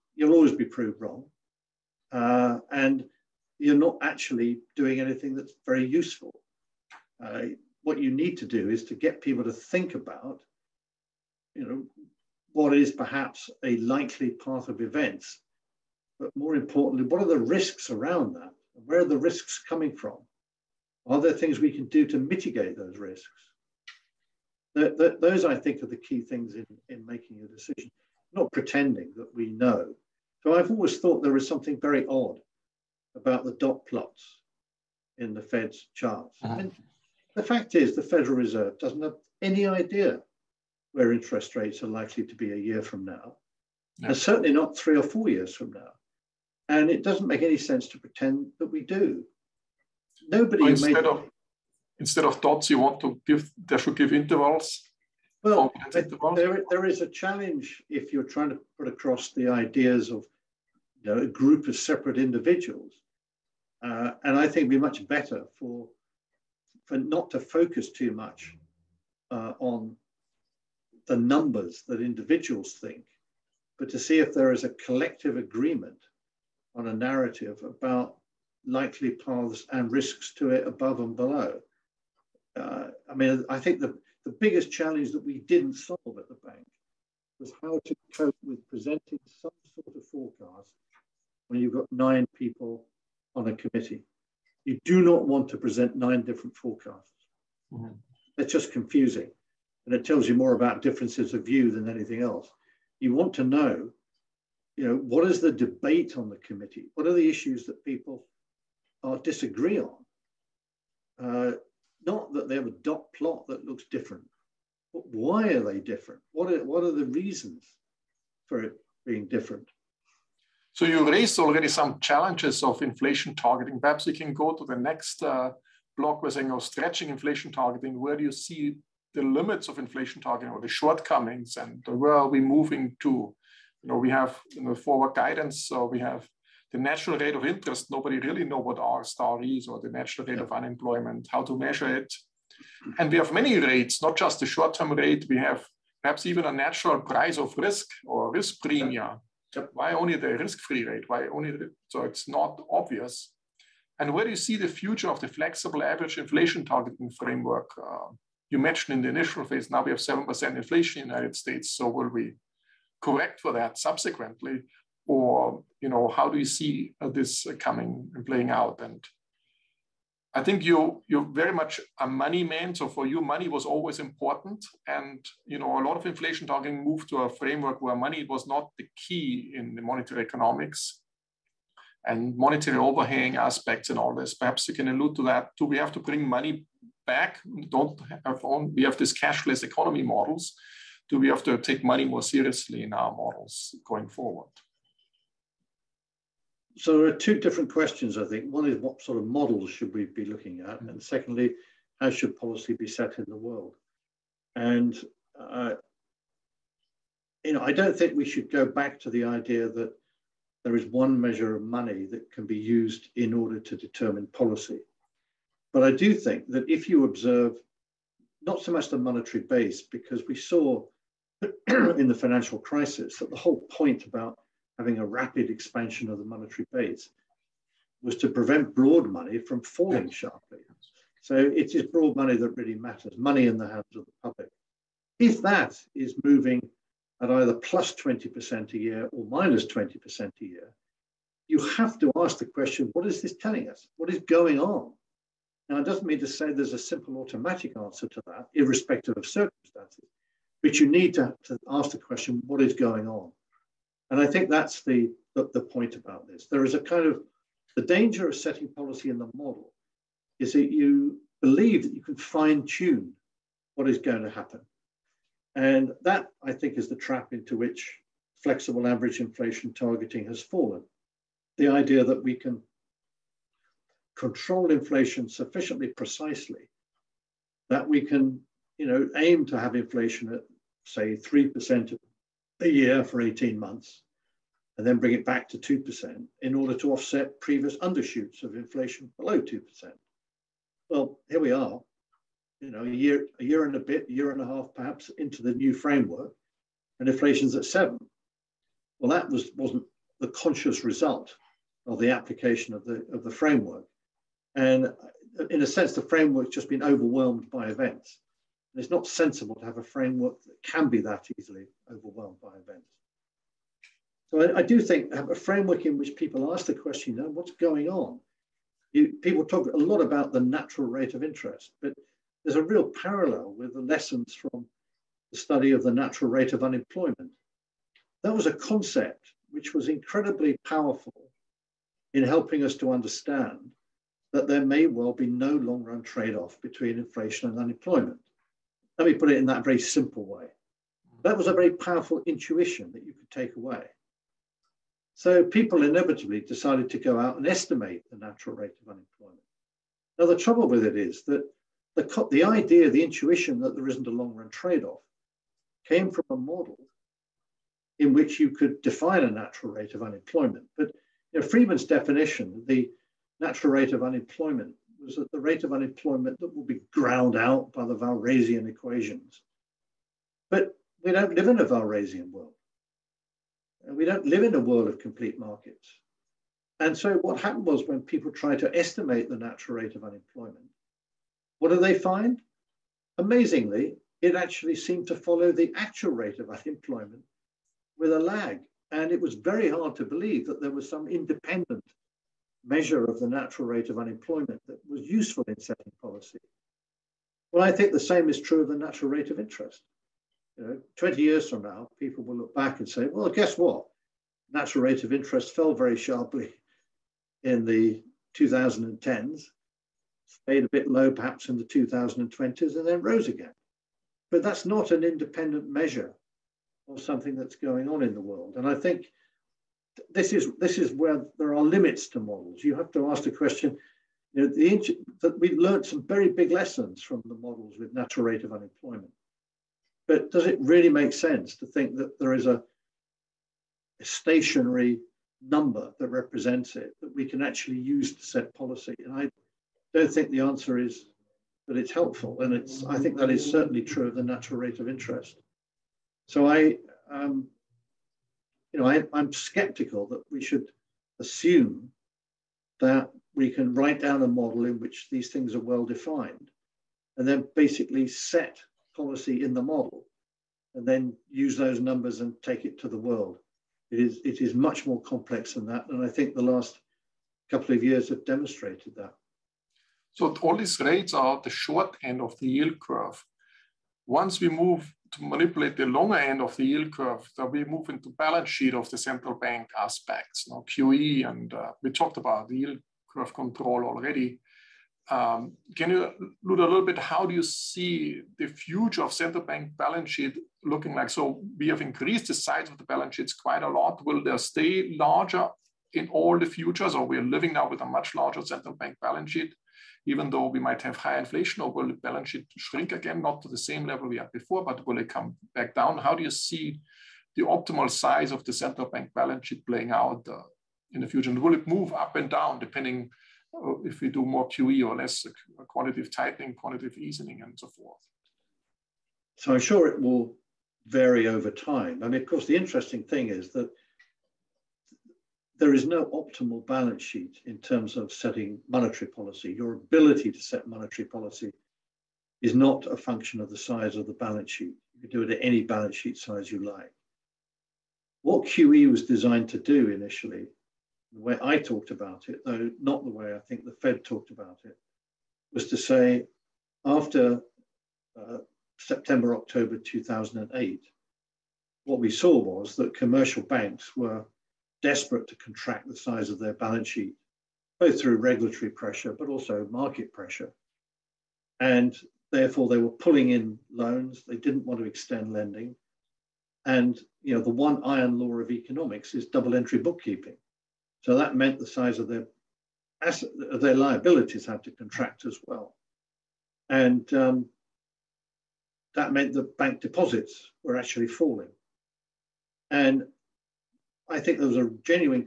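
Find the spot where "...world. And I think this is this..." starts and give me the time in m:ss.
6:58.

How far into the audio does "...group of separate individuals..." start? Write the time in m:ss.
1:01.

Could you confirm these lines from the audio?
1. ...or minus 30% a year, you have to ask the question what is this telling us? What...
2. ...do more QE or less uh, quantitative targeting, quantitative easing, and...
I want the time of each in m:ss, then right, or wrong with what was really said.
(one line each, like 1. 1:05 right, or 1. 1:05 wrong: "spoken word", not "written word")
1. 3:59 wrong: "20", not "30"
2. 8:34 wrong: "tightening", not "targeting".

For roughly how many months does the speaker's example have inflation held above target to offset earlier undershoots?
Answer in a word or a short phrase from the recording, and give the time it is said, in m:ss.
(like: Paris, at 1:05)
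18 months, at 4:43.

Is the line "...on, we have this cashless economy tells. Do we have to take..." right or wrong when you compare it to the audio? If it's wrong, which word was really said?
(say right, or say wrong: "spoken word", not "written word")
wrong: "models", not "tells".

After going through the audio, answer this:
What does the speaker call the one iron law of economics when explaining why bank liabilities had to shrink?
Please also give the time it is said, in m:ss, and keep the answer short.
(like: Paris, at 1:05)
Double entry bookkeeping, at 9:29.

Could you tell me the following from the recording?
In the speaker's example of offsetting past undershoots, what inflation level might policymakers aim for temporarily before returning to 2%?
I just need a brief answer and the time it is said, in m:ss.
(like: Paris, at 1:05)
3%, at 4:41.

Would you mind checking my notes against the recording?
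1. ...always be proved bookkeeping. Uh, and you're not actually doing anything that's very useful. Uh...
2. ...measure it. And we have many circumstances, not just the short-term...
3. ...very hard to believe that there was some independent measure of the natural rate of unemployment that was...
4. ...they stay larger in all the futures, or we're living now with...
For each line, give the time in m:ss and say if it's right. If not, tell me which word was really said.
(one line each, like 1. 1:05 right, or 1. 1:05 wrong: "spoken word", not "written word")
1. 0:00 wrong: "wrong", not "bookkeeping"
2. 2:21 wrong: "rates", not "circumstances"
3. 6:29 right
4. 8:14 right.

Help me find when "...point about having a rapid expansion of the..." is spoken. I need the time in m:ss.
3:43.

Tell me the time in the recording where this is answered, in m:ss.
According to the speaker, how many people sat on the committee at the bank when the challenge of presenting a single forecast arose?
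1:31.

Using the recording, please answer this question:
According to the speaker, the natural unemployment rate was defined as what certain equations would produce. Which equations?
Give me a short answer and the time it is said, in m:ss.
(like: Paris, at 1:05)
Walrasian equations, at 6:07.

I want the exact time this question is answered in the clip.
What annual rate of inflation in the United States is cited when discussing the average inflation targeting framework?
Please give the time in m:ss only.
2:39.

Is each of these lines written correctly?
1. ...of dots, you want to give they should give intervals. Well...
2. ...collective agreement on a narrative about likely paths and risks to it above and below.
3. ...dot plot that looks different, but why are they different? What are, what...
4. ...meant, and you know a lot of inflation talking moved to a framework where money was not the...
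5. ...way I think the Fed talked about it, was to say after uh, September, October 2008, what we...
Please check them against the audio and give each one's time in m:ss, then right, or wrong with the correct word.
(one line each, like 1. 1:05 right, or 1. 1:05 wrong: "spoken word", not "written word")
1. 0:52 right
2. 1:14 right
3. 1:52 right
4. 2:53 wrong: "important", not "meant"
5. 9:03 right.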